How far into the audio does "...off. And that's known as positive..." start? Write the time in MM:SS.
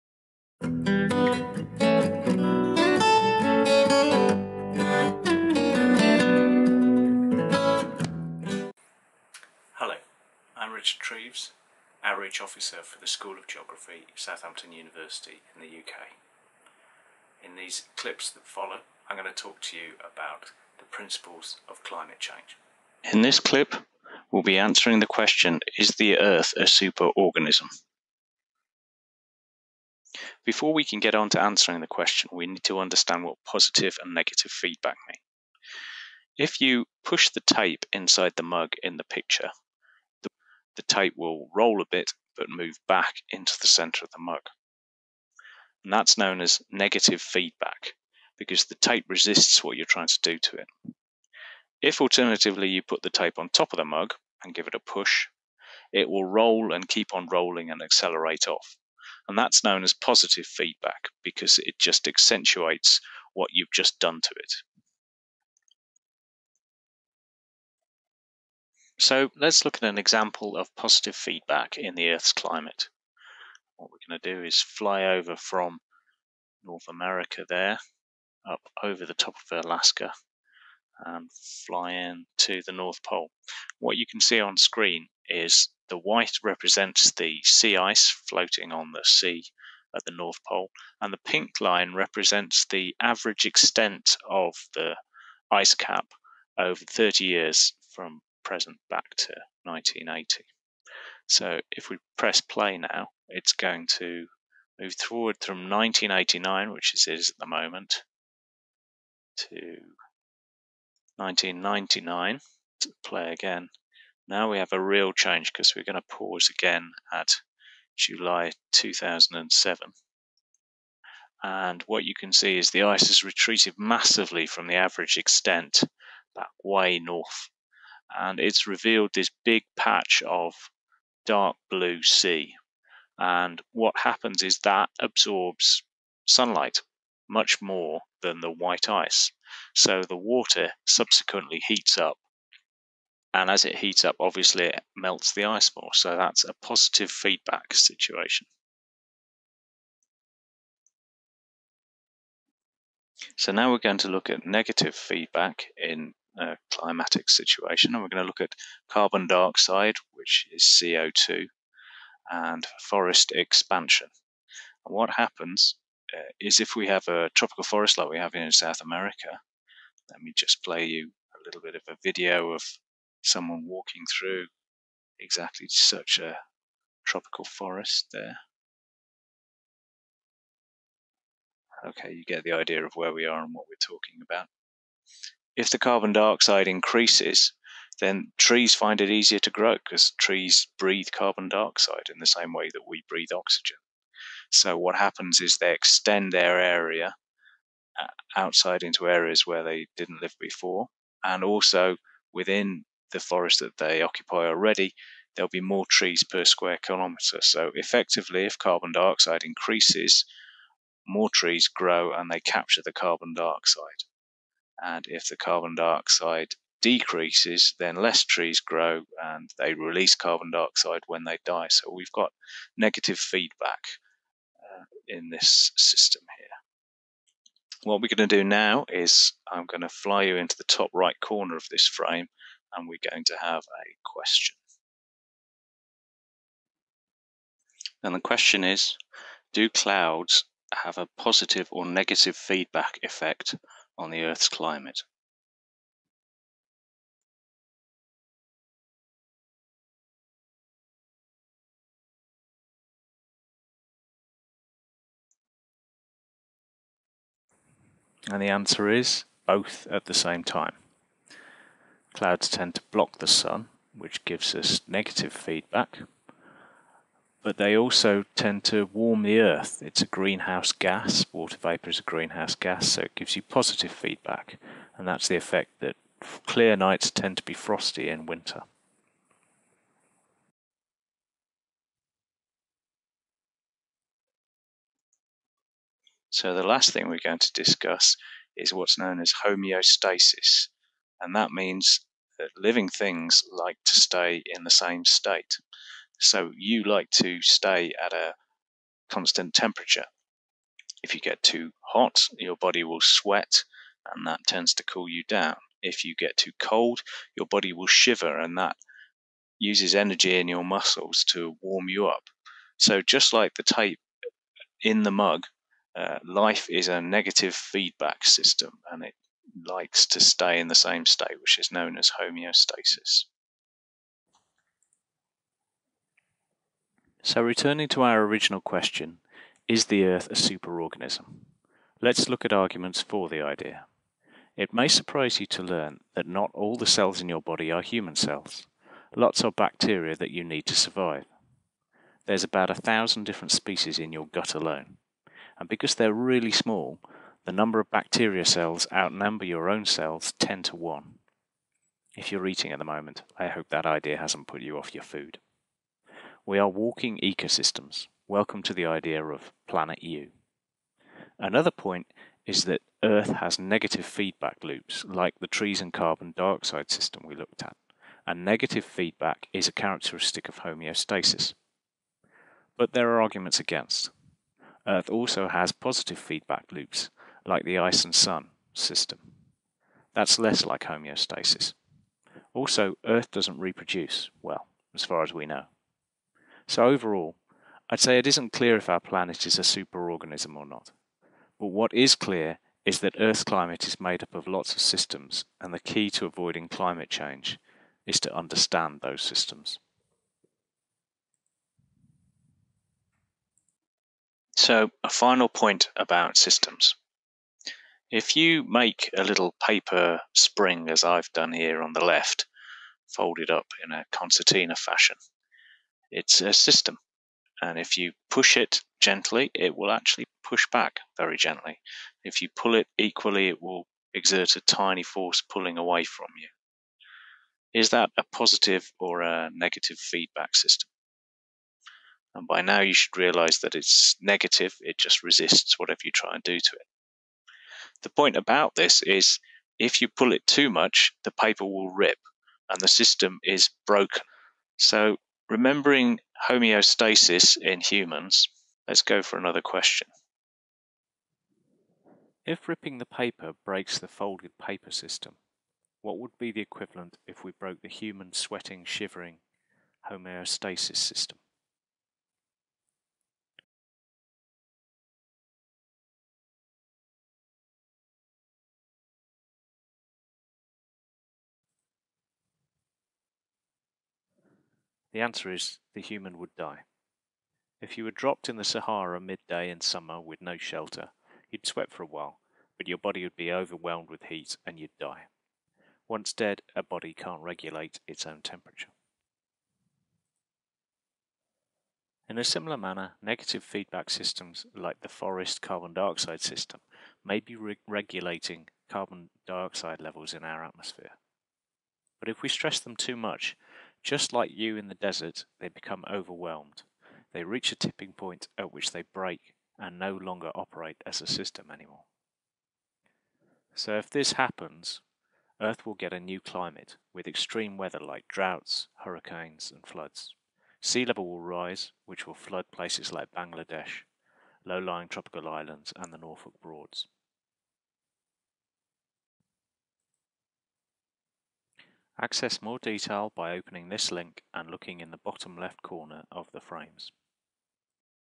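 00:58.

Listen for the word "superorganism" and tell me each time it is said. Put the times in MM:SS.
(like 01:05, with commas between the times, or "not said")
00:26, 05:30, 06:29.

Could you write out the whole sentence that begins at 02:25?
So that's a positive feedback situation.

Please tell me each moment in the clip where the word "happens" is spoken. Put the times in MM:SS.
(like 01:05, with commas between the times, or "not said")
02:14, 02:45, 03:14, 08:34.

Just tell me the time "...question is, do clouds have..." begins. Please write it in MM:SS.
03:58.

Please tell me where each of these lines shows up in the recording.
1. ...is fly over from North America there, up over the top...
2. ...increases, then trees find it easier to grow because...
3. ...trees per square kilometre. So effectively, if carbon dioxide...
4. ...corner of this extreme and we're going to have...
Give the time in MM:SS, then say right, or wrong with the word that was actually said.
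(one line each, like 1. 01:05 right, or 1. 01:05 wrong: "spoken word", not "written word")
1. 01:14 right
2. 03:06 right
3. 03:25 right
4. 03:51 wrong: "frame", not "extreme".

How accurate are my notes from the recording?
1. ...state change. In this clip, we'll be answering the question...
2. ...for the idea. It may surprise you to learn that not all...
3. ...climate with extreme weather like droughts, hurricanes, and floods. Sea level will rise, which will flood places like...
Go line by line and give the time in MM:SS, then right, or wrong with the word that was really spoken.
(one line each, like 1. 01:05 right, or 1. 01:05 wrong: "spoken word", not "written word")
1. 00:21 wrong: "climate", not "state"
2. 05:33 right
3. 08:36 right.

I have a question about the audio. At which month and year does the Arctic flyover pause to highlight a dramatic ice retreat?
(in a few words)
July 2007.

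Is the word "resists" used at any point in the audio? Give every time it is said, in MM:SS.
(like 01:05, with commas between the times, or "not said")
00:49, 07:15.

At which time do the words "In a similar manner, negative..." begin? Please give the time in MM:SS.
08:12.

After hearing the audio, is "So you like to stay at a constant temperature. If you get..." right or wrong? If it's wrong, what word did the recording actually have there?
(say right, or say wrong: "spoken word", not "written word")
right.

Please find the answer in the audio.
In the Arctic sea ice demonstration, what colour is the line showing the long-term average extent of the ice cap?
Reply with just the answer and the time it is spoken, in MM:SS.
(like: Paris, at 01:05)
Pink, at 01:31.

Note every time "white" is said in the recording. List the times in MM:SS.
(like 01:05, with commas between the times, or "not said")
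01:25, 02:18.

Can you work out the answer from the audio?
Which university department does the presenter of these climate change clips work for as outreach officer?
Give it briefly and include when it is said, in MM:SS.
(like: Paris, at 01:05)
School of Geography, at 00:13.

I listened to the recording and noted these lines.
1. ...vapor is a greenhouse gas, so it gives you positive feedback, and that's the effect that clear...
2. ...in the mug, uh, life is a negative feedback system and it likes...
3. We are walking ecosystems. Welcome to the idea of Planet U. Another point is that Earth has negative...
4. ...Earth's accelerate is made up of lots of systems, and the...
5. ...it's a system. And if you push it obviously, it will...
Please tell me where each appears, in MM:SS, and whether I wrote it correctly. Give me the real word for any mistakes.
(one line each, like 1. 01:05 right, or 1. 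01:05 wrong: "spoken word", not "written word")
1. 04:31 right
2. 05:14 right
3. 05:56 right
4. 06:33 wrong: "climate", not "accelerate"
5. 06:56 wrong: "gently", not "obviously".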